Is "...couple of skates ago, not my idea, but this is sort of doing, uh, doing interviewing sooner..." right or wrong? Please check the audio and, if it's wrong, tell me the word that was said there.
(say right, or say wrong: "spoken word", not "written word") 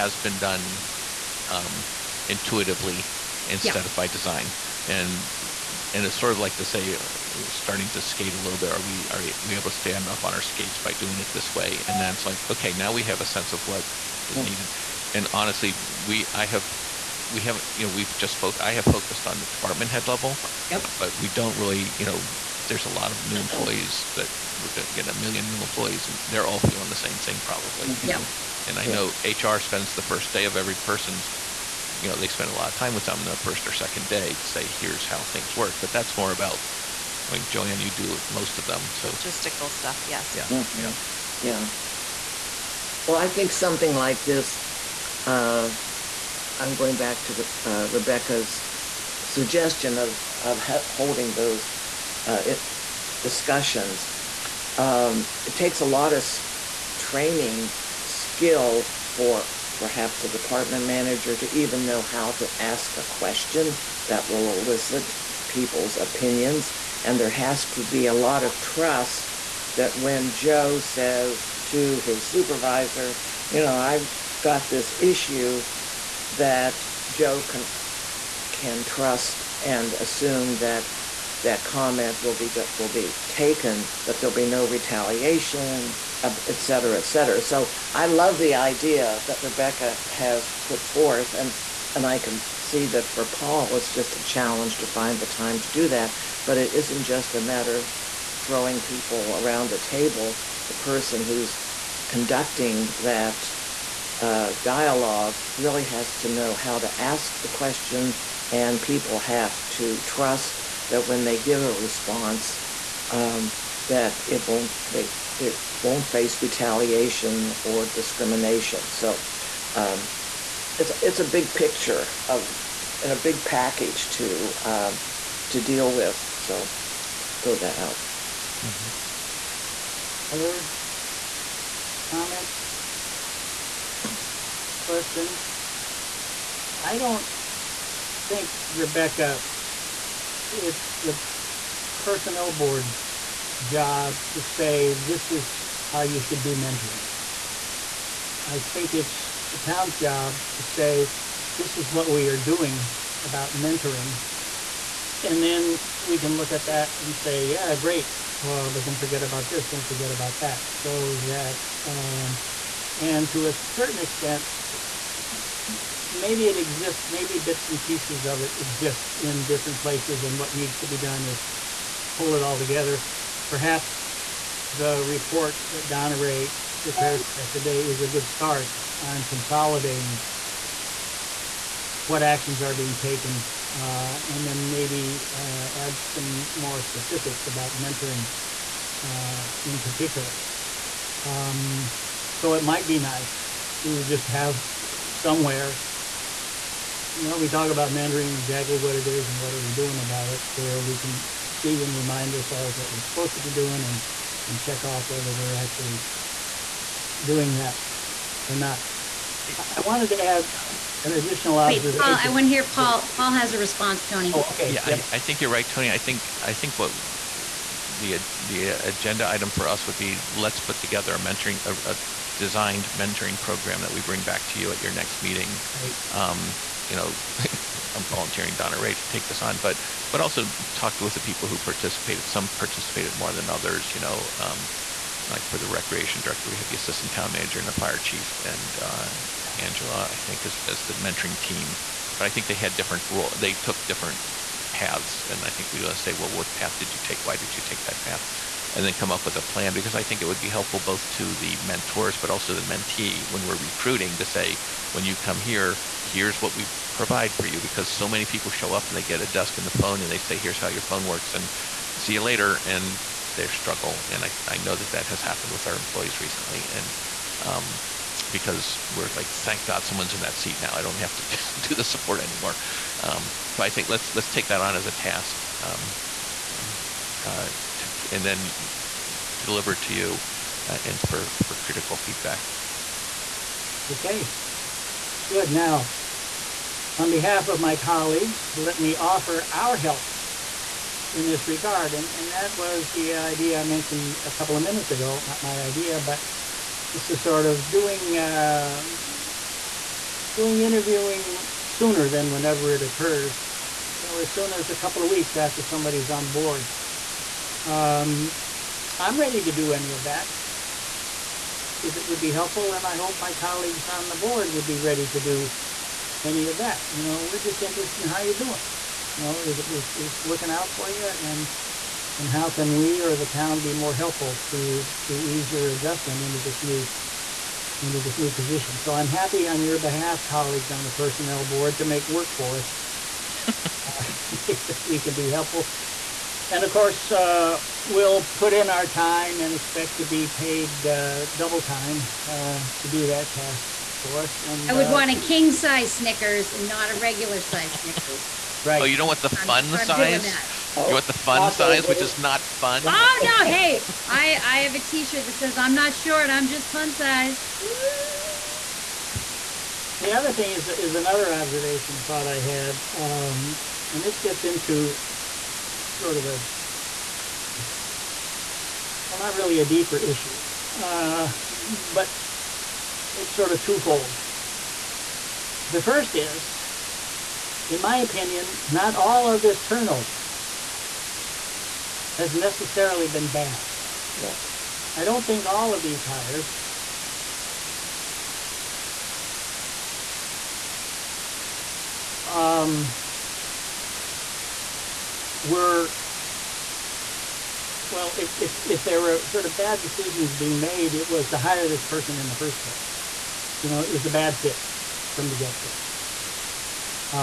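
wrong: "minutes", not "skates".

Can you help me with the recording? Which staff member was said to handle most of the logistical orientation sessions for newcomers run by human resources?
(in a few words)
Joanne.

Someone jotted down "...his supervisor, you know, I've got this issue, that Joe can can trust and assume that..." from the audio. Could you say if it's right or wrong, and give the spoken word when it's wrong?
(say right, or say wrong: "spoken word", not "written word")
right.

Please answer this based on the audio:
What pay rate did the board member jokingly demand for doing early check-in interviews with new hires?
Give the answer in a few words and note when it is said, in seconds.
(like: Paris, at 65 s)
double time, at 341 s.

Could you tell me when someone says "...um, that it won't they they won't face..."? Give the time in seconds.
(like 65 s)
113 s.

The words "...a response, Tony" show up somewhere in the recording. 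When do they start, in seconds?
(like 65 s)
213 s.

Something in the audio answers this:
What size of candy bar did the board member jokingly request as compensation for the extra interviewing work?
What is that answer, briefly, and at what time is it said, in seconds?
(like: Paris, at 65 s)
king size, at 345 s.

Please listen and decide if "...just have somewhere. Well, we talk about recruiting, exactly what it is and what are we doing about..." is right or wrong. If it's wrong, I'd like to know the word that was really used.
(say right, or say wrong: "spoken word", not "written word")
wrong: "mentoring", not "recruiting".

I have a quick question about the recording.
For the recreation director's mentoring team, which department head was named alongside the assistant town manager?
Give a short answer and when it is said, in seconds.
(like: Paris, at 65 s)
the fire chief, at 237 s.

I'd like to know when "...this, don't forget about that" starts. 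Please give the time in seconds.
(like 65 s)
159 s.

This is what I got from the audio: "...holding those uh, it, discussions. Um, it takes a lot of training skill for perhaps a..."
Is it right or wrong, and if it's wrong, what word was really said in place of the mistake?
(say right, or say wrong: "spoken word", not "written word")
right.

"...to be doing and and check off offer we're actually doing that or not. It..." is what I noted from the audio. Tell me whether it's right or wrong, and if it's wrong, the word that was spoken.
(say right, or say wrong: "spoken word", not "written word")
wrong: "whether", not "offer".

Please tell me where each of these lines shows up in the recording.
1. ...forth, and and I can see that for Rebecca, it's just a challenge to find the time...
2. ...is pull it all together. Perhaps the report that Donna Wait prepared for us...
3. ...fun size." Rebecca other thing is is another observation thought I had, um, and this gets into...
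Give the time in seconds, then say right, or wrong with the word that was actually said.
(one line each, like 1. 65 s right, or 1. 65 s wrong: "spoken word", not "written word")
1. 90 s wrong: "Paul", not "Rebecca"
2. 171 s wrong: "Ray", not "Wait"
3. 356 s wrong: "The", not "Rebecca".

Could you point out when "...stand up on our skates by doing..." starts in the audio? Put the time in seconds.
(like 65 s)
9 s.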